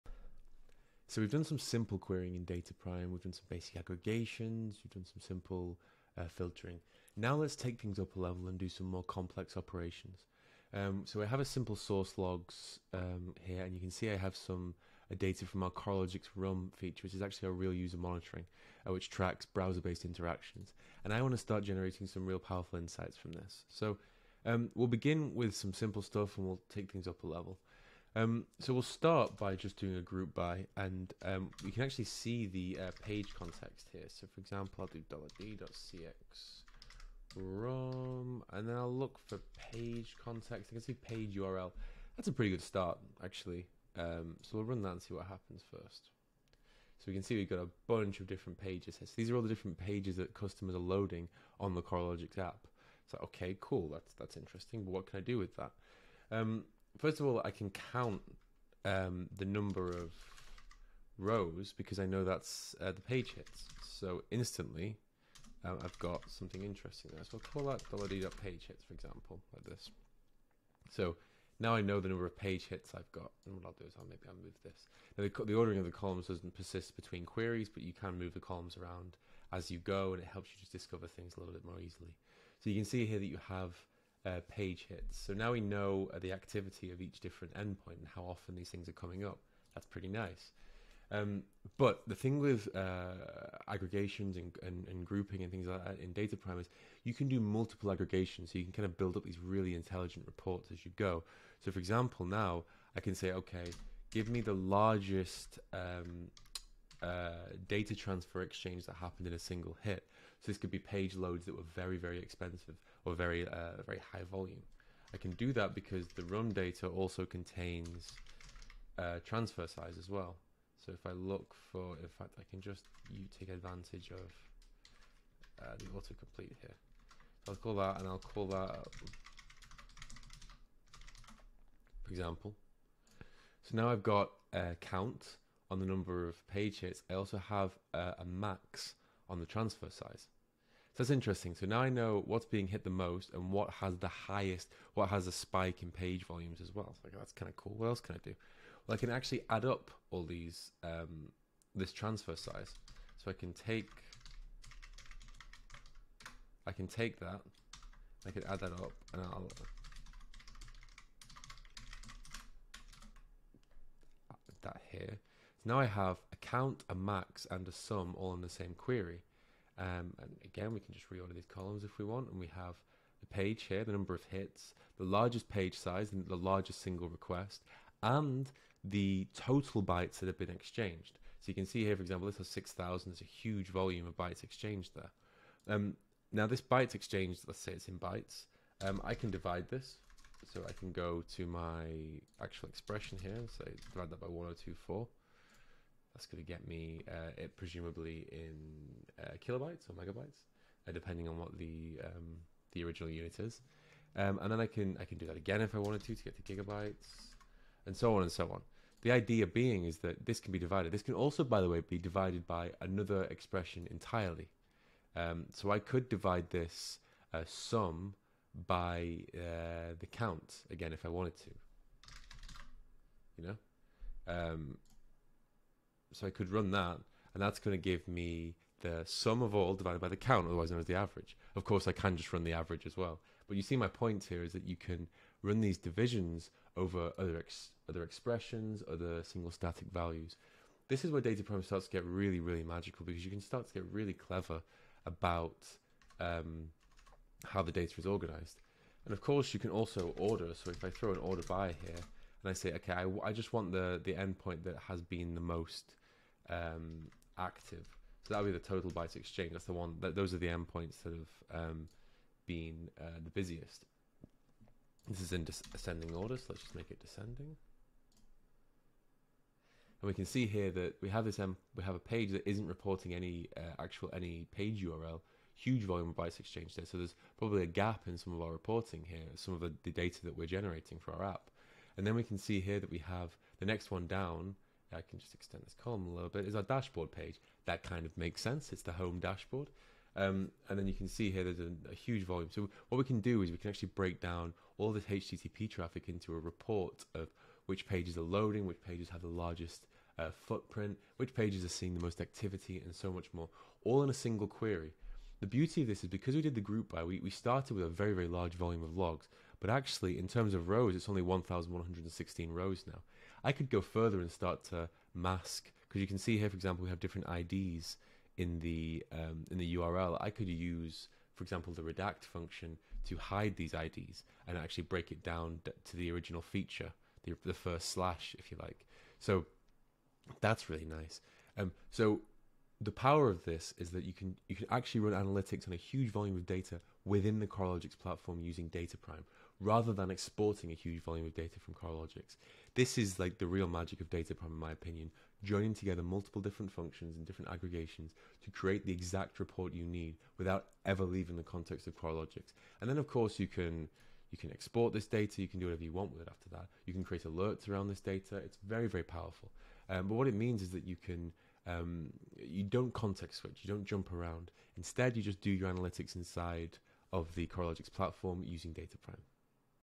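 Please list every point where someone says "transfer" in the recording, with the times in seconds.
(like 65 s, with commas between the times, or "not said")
107 s, 119 s, 139 s, 151 s.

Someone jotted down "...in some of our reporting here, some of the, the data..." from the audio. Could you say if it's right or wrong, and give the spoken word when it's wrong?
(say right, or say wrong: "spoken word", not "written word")
right.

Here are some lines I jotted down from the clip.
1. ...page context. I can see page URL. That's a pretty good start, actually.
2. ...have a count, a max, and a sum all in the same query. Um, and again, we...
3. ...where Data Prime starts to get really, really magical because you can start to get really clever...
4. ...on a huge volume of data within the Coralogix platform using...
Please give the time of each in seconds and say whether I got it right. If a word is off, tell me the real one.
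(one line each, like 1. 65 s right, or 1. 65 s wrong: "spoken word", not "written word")
1. 39 s right
2. 165 s right
3. 241 s right
4. 335 s right.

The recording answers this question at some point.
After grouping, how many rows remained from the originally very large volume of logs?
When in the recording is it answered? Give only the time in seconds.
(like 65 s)
311 s.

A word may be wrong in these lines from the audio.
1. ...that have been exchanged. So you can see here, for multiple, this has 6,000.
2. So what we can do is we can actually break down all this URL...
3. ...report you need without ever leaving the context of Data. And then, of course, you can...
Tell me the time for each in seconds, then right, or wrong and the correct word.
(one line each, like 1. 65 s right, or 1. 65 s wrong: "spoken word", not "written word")
1. 180 s wrong: "example", not "multiple"
2. 292 s wrong: "HTTP", not "URL"
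3. 349 s wrong: "Coralogix", not "Data".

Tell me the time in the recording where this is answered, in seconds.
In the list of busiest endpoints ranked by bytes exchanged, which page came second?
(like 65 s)
288 s.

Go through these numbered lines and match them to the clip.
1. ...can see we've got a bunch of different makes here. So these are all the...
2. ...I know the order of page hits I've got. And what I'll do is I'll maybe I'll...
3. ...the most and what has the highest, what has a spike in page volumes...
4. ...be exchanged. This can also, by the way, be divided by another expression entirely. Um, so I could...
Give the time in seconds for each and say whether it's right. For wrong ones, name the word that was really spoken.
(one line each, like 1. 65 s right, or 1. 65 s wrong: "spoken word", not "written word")
1. 47 s wrong: "pages", not "makes"
2. 71 s wrong: "number", not "order"
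3. 142 s right
4. 210 s wrong: "divided", not "exchanged".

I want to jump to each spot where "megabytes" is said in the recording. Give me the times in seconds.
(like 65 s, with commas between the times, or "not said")
199 s.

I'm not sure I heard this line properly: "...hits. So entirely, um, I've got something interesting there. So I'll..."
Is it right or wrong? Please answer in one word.
wrong.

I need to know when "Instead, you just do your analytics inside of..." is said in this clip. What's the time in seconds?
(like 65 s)
364 s.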